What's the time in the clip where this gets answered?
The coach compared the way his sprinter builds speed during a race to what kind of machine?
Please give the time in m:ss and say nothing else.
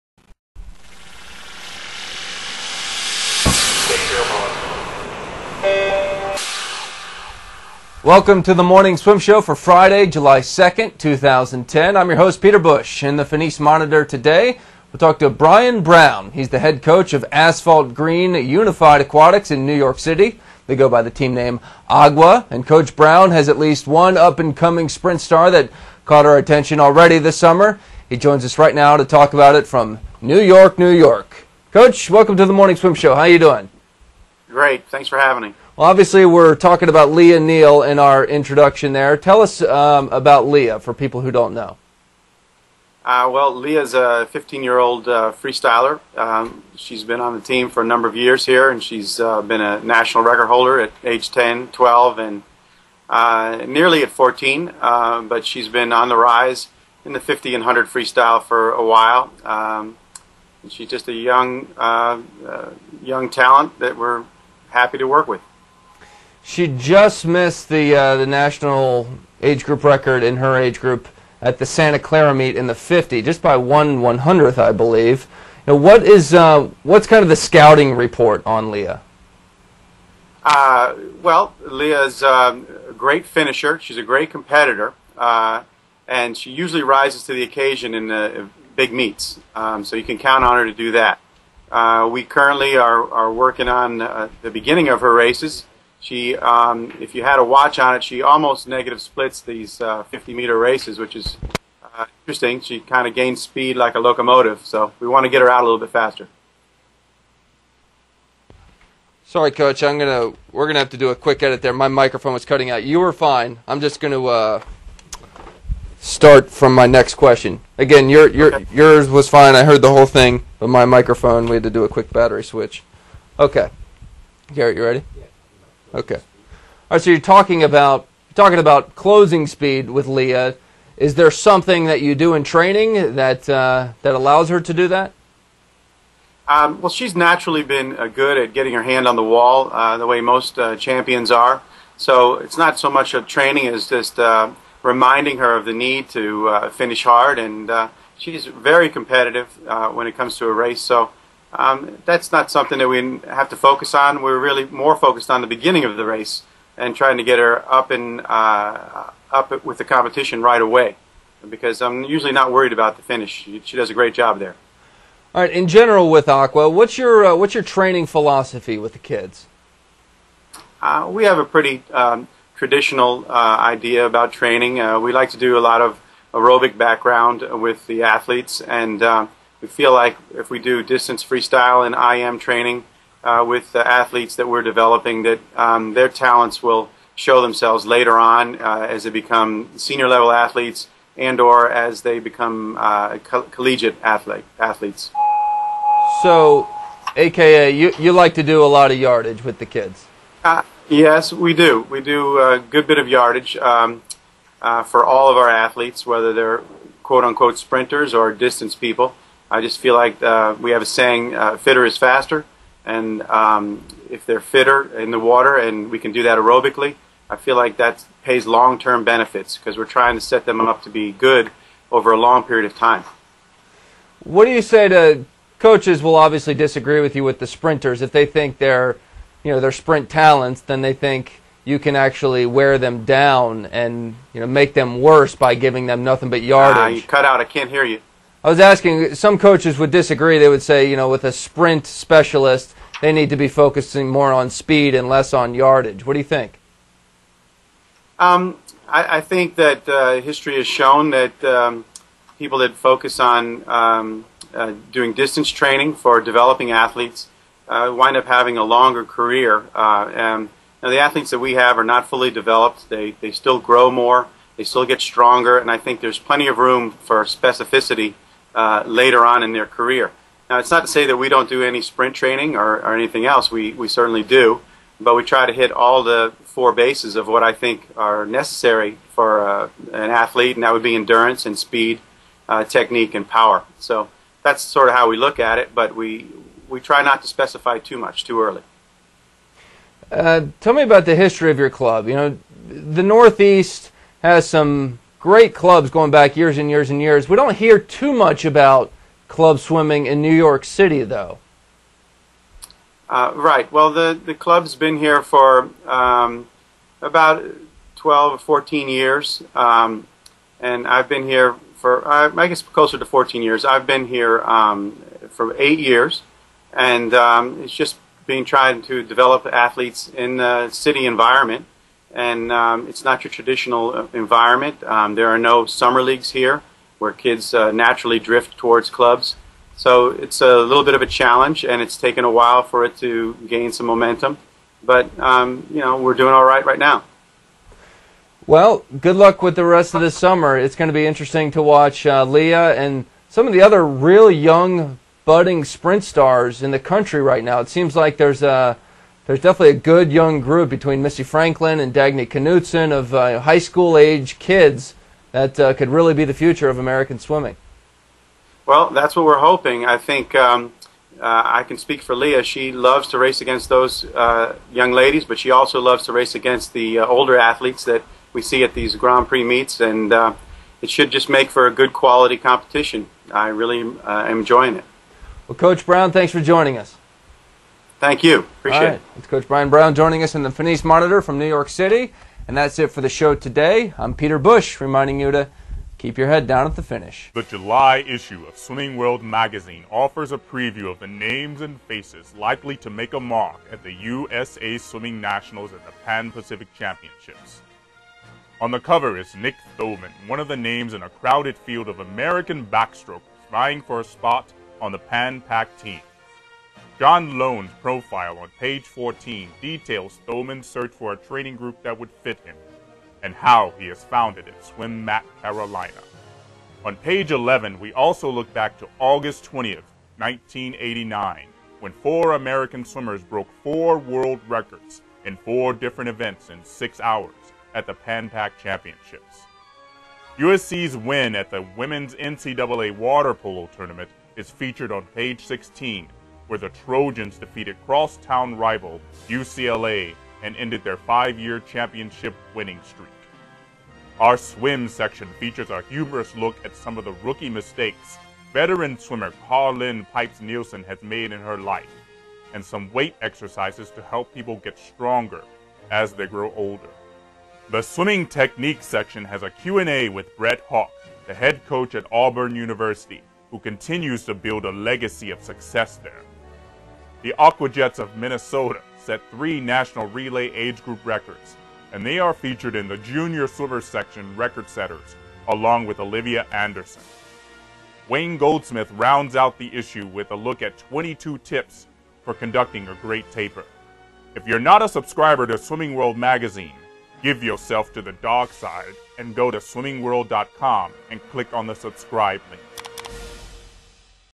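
1:43.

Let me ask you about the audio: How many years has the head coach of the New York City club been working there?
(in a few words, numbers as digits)
8.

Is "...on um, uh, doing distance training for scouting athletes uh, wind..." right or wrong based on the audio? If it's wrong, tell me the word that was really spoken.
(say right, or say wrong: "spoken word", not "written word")
wrong: "developing", not "scouting".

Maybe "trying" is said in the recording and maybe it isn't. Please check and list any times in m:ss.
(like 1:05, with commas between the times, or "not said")
2:36, 3:39, 5:18.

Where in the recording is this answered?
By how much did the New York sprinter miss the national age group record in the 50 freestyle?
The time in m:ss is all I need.
1:13.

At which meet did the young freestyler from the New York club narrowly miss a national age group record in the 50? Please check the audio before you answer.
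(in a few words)
Santa Clara.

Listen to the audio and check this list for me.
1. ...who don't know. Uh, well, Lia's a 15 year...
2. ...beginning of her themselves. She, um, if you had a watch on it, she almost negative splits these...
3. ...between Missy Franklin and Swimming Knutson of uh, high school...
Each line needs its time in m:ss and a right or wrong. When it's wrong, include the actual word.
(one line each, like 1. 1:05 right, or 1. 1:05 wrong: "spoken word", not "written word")
1. 0:41 right
2. 1:34 wrong: "races", not "themselves"
3. 5:50 wrong: "Dagny", not "Swimming".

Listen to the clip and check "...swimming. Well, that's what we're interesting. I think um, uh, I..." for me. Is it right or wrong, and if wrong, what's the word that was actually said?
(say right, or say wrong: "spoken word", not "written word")
wrong: "hoping", not "interesting".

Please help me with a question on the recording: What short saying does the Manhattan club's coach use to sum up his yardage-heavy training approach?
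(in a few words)
fitter is faster.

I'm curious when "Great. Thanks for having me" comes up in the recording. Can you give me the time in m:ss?
0:34.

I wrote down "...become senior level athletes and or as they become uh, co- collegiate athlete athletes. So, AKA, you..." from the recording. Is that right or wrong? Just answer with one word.
right.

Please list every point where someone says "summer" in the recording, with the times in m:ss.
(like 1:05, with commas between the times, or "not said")
0:27, 5:25, 5:40.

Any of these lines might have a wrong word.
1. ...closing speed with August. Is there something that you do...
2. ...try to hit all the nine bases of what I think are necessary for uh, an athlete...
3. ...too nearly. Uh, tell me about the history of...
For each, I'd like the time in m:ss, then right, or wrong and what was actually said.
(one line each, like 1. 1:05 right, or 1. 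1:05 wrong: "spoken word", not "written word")
1. 2:08 wrong: "Lia", not "August"
2. 4:35 wrong: "four", not "nine"
3. 4:48 wrong: "early", not "nearly".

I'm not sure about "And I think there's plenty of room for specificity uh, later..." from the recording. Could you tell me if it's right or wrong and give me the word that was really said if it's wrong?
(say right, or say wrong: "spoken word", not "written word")
right.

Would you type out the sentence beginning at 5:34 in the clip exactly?
But, um, you know, we're doing all right right now.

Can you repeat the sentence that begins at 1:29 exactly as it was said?
Um, so you can count on her to do that.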